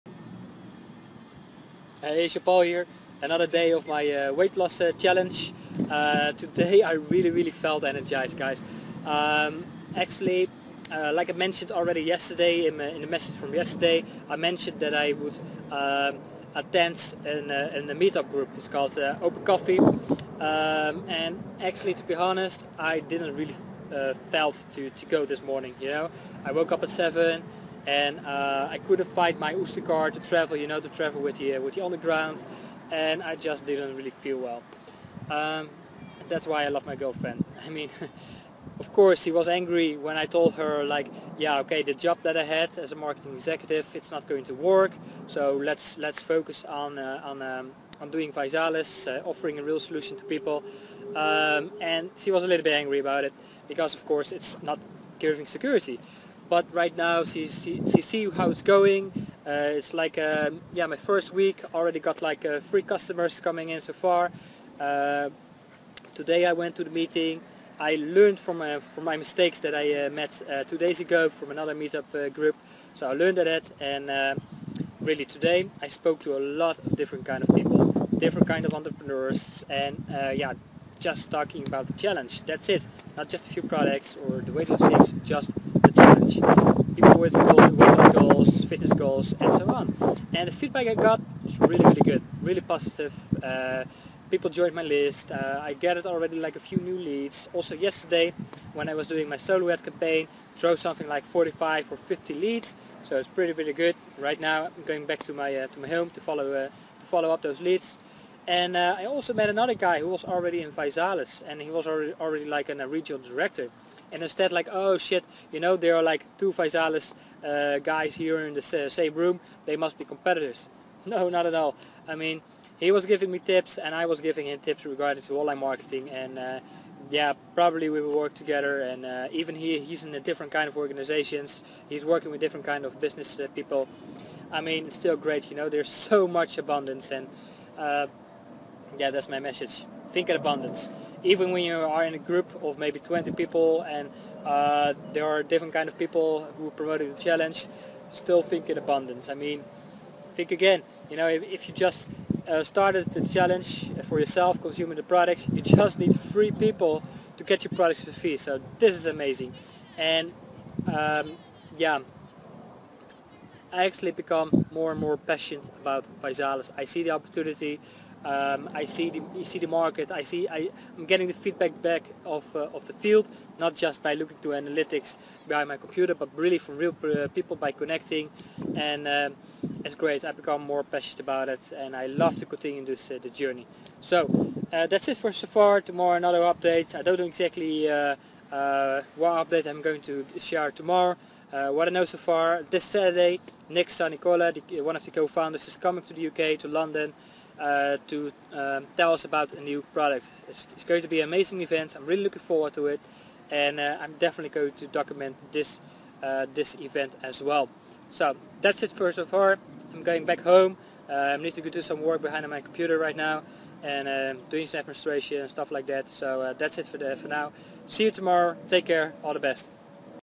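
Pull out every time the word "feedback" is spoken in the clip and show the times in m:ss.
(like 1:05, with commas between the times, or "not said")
1:30, 2:51.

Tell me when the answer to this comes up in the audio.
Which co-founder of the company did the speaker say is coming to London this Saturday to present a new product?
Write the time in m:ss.
3:13.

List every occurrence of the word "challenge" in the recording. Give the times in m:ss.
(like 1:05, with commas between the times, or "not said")
0:04, 1:21, 1:26, 2:27, 2:33.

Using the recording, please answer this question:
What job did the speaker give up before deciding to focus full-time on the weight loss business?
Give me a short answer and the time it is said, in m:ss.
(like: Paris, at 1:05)
marketing executive, at 0:42.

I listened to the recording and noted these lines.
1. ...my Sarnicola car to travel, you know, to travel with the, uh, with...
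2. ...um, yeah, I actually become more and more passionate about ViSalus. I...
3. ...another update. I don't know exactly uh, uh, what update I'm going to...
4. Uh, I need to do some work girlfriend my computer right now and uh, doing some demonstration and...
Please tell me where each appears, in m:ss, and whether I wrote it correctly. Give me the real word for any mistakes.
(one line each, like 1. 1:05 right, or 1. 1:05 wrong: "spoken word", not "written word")
1. 0:29 wrong: "Oyster", not "Sarnicola"
2. 2:40 right
3. 3:06 right
4. 3:31 wrong: "behind", not "girlfriend".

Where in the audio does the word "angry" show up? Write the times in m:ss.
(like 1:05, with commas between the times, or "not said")
0:39, 0:52.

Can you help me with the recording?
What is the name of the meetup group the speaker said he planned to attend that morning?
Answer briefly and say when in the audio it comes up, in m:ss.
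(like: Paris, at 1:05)
Open Coffee, at 0:18.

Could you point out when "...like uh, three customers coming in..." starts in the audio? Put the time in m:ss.
1:02.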